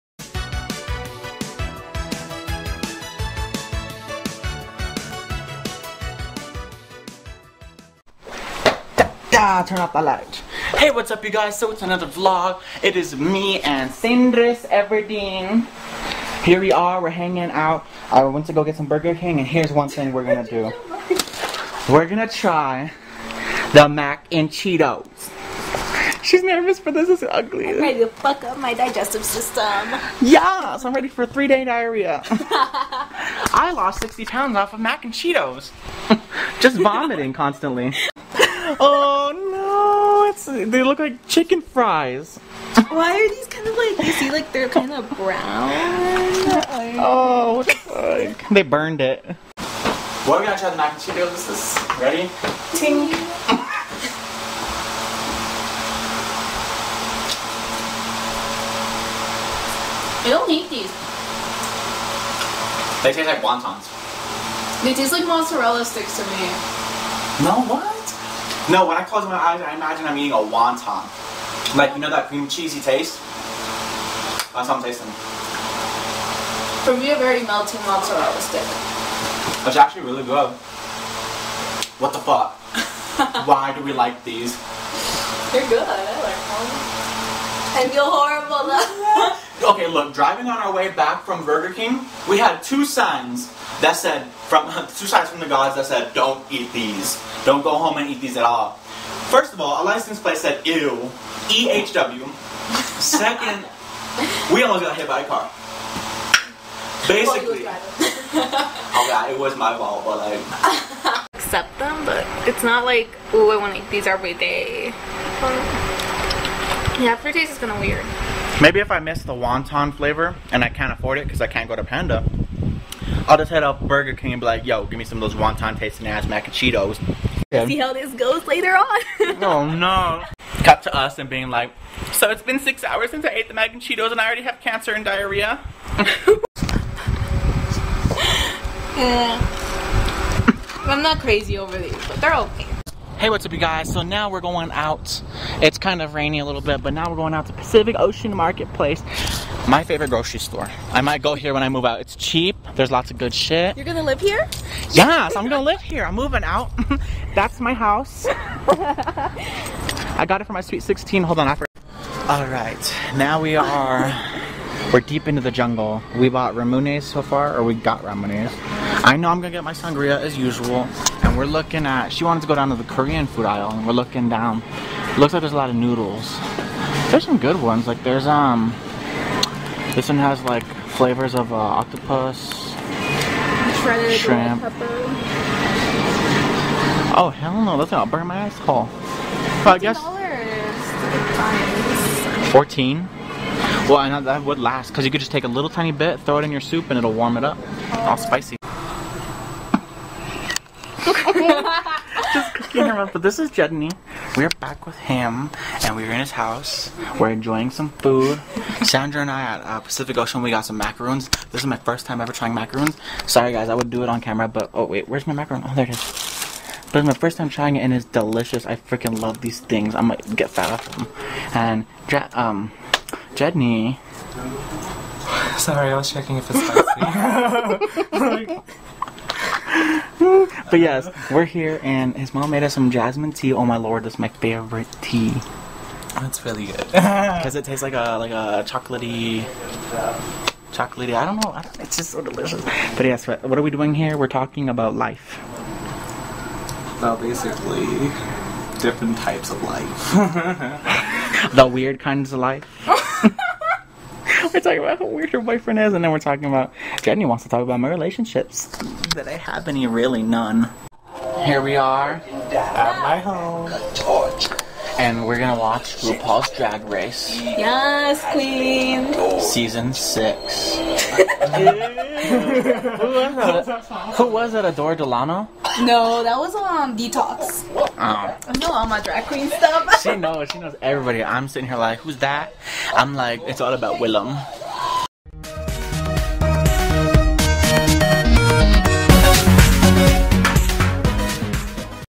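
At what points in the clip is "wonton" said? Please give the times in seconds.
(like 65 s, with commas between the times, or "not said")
63 s, 70 s, 119 s, 125 s.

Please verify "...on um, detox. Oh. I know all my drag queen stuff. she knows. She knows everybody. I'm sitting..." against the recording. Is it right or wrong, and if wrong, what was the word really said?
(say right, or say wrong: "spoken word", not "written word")
right.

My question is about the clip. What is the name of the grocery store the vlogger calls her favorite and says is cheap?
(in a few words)
Pacific Ocean Marketplace.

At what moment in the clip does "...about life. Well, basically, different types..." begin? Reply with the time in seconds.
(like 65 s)
244 s.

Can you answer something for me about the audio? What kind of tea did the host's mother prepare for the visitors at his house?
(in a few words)
jasmine tea.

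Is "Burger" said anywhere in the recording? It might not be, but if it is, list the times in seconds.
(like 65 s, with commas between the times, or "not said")
18 s, 91 s, 123 s.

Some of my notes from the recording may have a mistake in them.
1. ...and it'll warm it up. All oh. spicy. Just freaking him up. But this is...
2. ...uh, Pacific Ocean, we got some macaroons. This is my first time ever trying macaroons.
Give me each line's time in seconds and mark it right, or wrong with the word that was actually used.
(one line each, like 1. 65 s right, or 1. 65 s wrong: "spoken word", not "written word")
1. 196 s wrong: "cooking", not "freaking"
2. 209 s right.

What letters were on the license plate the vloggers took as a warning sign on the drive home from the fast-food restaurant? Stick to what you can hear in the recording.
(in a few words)
EHW.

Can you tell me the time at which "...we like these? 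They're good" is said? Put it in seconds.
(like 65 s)
83 s.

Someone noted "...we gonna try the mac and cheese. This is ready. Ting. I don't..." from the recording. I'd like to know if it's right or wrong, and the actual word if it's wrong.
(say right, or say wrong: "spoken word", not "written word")
right.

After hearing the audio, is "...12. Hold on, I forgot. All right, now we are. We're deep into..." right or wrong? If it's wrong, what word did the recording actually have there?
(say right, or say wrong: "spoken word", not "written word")
wrong: "16", not "12".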